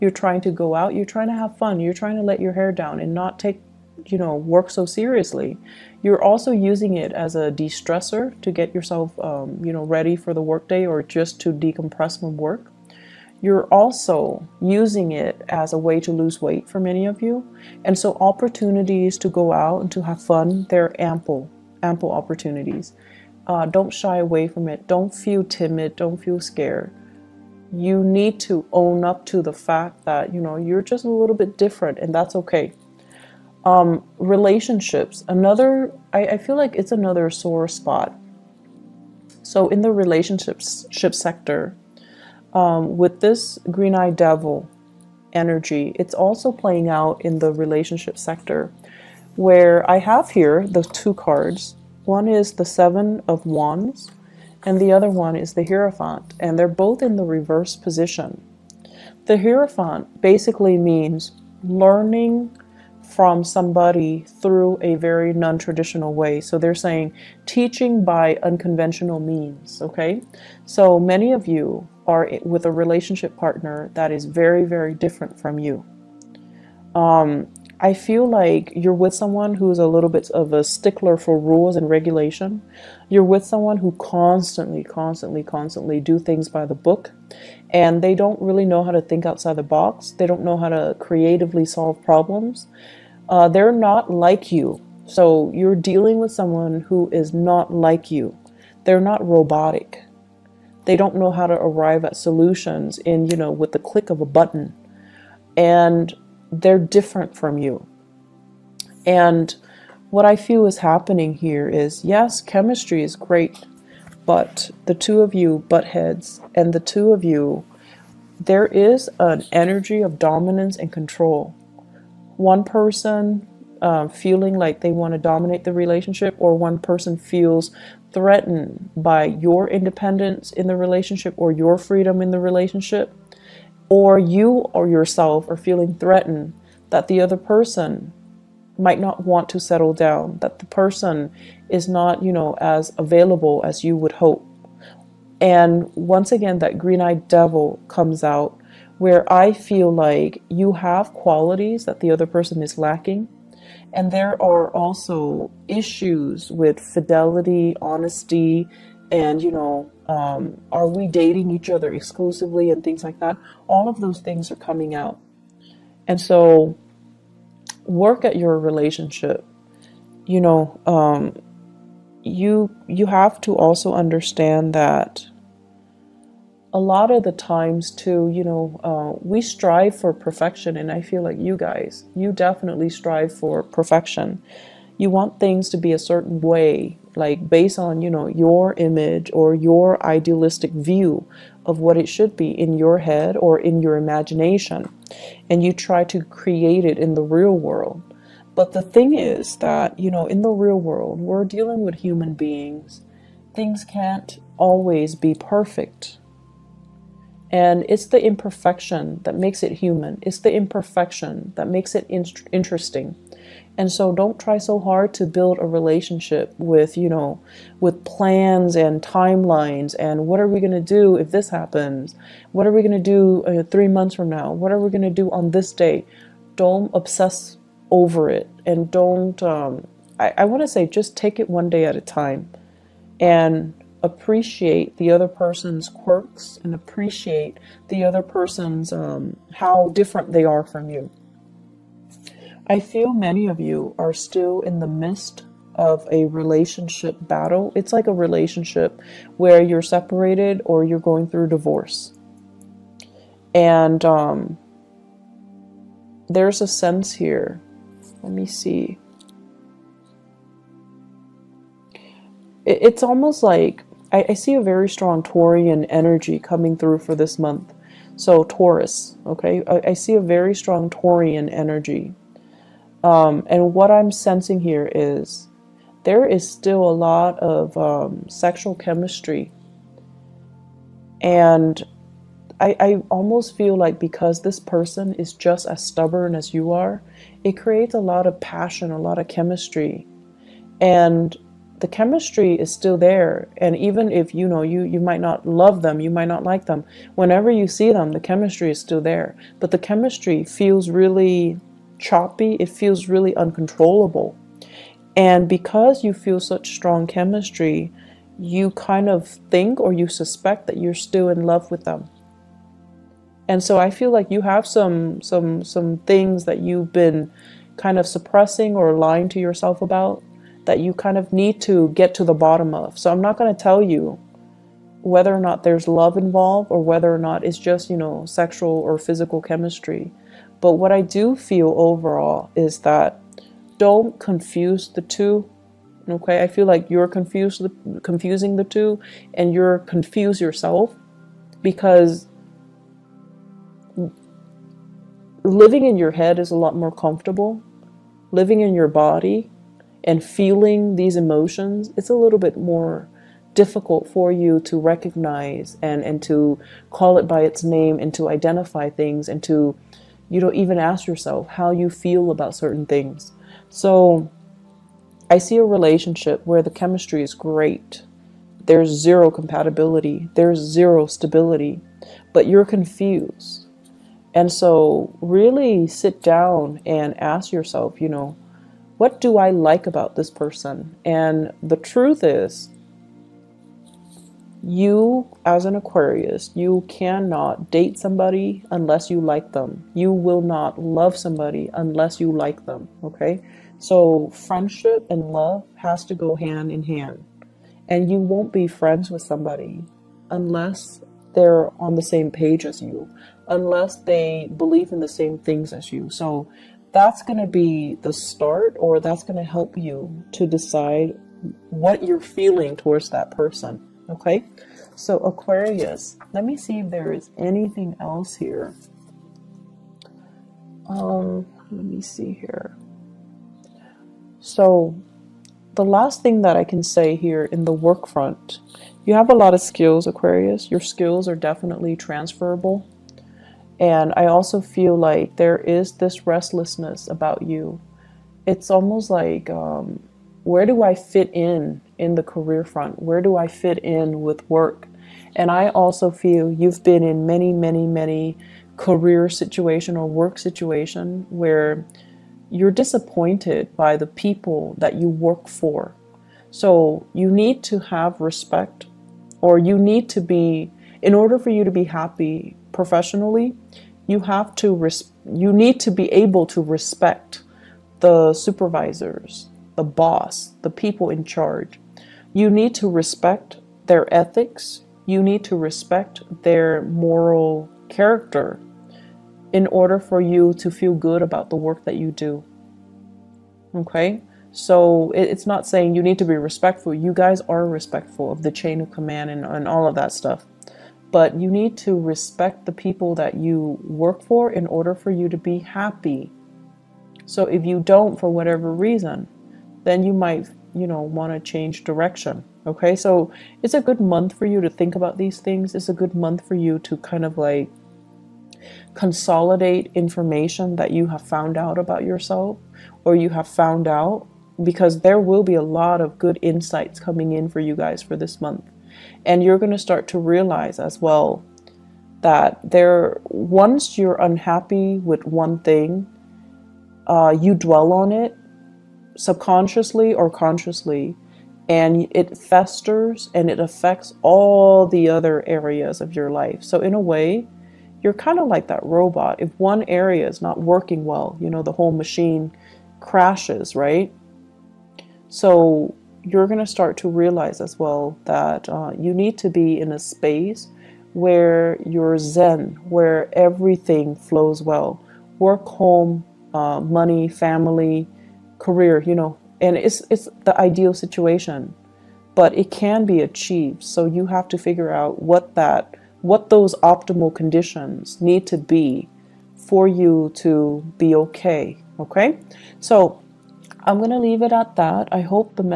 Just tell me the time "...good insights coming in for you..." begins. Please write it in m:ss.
8:36.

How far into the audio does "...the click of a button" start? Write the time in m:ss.
1:43.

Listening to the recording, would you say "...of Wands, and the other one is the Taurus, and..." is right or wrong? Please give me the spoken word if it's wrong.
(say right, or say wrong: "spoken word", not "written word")
wrong: "Hierophant", not "Taurus".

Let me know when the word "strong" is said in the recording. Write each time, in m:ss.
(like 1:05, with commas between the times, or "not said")
4:24, 4:30, 5:06.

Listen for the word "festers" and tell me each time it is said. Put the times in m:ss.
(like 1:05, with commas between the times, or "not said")
8:52.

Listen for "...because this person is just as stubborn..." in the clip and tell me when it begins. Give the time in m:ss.
4:43.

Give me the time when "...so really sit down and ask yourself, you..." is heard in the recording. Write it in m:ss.
6:14.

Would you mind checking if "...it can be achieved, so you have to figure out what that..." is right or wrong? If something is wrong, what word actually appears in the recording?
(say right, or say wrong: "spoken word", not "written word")
right.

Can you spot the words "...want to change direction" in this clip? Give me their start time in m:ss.
8:21.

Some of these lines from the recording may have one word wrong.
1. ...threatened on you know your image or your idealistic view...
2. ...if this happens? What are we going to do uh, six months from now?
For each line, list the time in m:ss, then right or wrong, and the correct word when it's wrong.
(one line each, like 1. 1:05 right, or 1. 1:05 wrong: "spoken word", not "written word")
1. 3:07 wrong: "based", not "threatened"
2. 3:41 wrong: "three", not "six".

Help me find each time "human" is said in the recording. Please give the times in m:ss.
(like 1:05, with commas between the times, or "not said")
3:21, 3:29.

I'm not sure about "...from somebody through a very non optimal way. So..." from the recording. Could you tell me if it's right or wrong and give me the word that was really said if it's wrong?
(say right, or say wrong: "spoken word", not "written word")
wrong: "traditional", not "optimal".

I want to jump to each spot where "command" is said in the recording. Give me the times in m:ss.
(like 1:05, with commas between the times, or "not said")
8:08.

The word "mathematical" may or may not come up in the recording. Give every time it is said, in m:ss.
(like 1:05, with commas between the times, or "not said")
not said.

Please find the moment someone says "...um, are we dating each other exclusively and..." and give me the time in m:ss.
2:40.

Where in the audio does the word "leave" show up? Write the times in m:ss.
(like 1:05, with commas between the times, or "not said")
9:34.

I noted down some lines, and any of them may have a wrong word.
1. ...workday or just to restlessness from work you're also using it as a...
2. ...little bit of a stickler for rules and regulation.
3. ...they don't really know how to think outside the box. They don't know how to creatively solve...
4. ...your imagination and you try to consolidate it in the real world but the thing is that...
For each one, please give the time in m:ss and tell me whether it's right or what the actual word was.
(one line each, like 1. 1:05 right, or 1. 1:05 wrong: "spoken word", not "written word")
1. 0:10 wrong: "decompress", not "restlessness"
2. 1:19 right
3. 1:28 right
4. 3:13 wrong: "create", not "consolidate".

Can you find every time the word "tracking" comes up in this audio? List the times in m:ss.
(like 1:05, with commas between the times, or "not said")
not said.